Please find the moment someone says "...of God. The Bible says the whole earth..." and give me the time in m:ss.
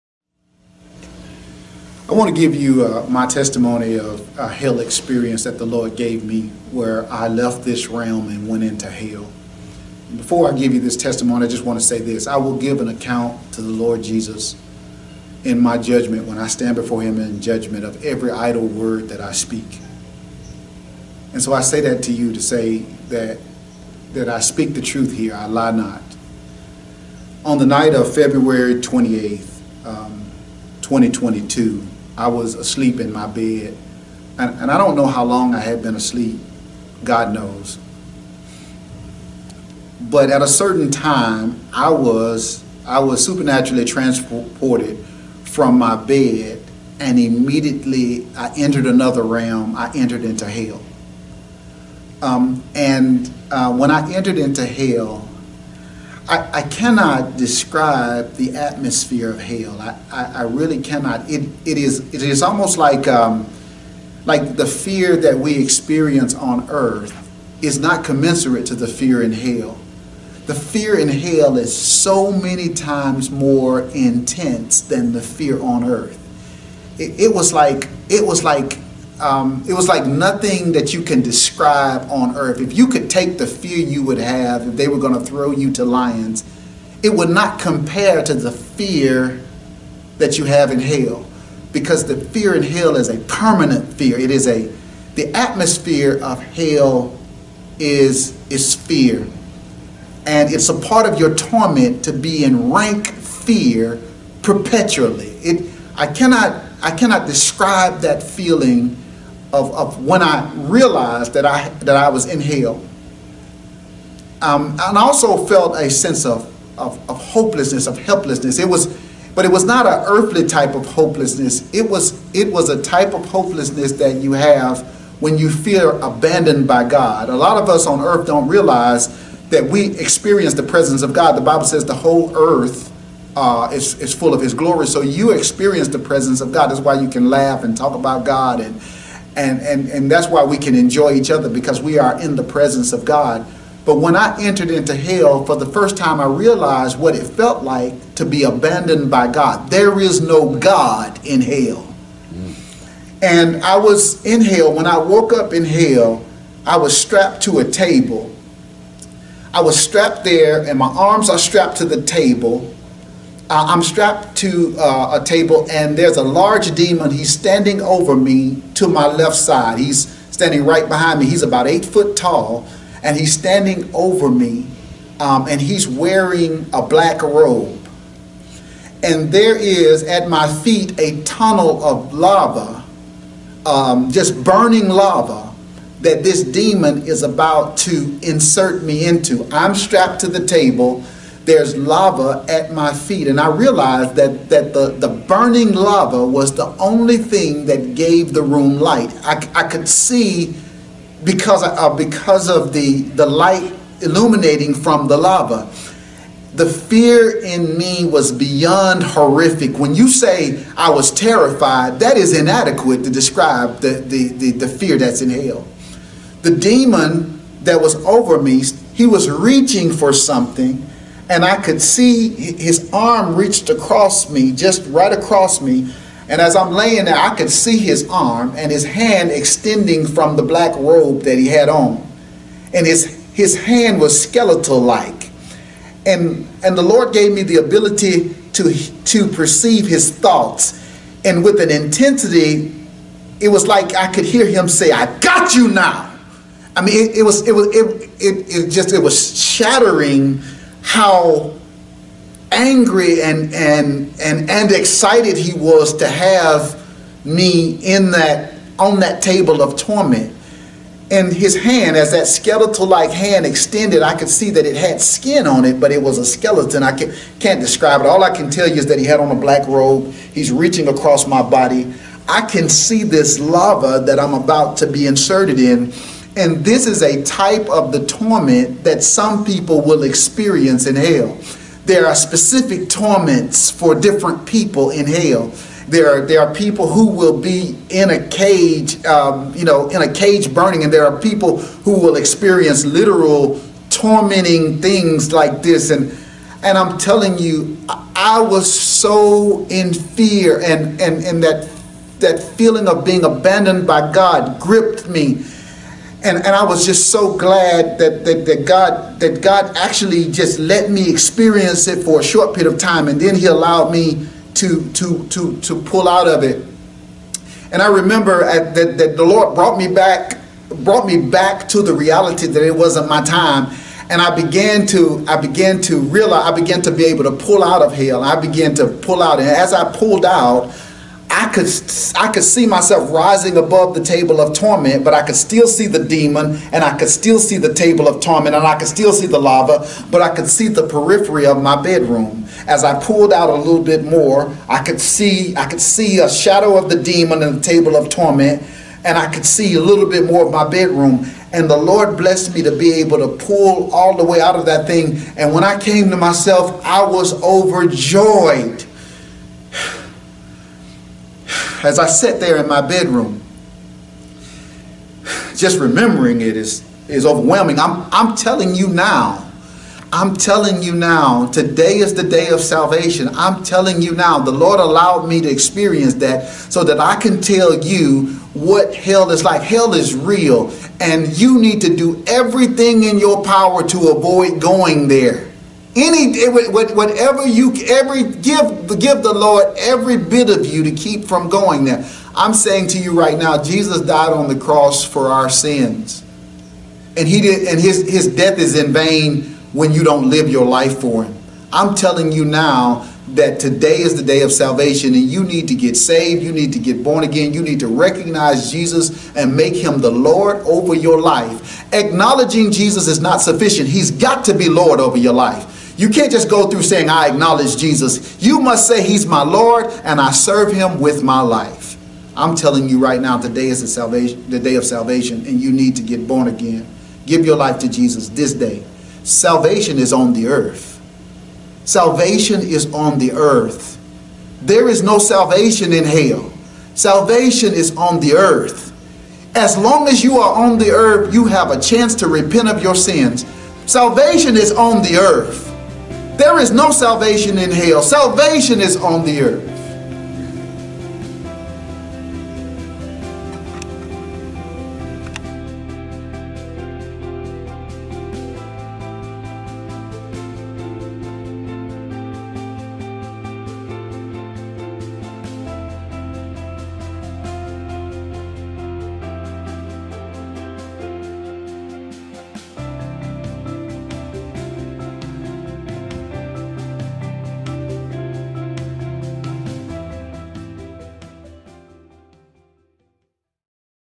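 2:11.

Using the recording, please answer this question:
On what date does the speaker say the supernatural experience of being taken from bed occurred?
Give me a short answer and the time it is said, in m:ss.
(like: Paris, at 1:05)
February 28th, 2022, at 0:28.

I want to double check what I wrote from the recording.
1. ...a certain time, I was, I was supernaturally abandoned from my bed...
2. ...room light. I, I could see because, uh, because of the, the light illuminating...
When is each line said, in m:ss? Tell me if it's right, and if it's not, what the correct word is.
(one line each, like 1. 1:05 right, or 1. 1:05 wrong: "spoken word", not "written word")
1. 0:40 wrong: "transported", not "abandoned"
2. 3:18 right.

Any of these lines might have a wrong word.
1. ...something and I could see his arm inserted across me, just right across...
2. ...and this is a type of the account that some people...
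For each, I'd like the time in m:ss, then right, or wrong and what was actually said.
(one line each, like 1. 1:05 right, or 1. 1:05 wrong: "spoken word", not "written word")
1. 3:40 wrong: "reached", not "inserted"
2. 4:36 wrong: "torment", not "account".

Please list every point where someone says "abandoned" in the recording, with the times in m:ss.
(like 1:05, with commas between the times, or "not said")
2:06, 2:28, 5:03.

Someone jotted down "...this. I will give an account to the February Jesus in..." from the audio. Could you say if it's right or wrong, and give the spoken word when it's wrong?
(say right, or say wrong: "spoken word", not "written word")
wrong: "Lord", not "February".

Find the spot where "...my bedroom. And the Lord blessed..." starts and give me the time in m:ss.
5:50.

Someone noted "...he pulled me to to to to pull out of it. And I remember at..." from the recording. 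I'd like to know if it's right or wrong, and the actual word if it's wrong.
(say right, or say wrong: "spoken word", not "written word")
wrong: "allowed", not "pulled".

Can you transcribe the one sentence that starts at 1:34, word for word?
It is a the atmosphere of hell is is fear.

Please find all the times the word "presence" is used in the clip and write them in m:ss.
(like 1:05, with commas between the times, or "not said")
2:10, 2:15, 2:22.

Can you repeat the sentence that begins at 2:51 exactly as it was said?
He's about eight foot tall, and he's standing over me, um, and he's wearing a black robe.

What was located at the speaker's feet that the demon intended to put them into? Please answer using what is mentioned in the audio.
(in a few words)
A tunnel of lava.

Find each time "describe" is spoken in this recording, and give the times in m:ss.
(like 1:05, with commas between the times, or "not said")
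0:57, 1:21, 1:47, 3:33, 4:27.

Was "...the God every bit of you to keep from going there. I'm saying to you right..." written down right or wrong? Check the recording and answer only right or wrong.
wrong.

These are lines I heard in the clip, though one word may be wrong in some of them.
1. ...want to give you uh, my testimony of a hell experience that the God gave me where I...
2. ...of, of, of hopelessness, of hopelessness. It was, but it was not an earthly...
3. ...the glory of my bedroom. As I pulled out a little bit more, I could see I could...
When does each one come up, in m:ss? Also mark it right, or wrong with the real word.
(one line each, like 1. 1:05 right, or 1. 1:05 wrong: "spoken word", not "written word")
1. 0:02 wrong: "Lord", not "God"
2. 1:56 wrong: "helplessness", not "hopelessness"
3. 5:40 wrong: "periphery", not "glory".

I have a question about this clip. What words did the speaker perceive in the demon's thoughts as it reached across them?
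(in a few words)
I got you now.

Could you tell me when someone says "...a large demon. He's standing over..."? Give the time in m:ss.
2:46.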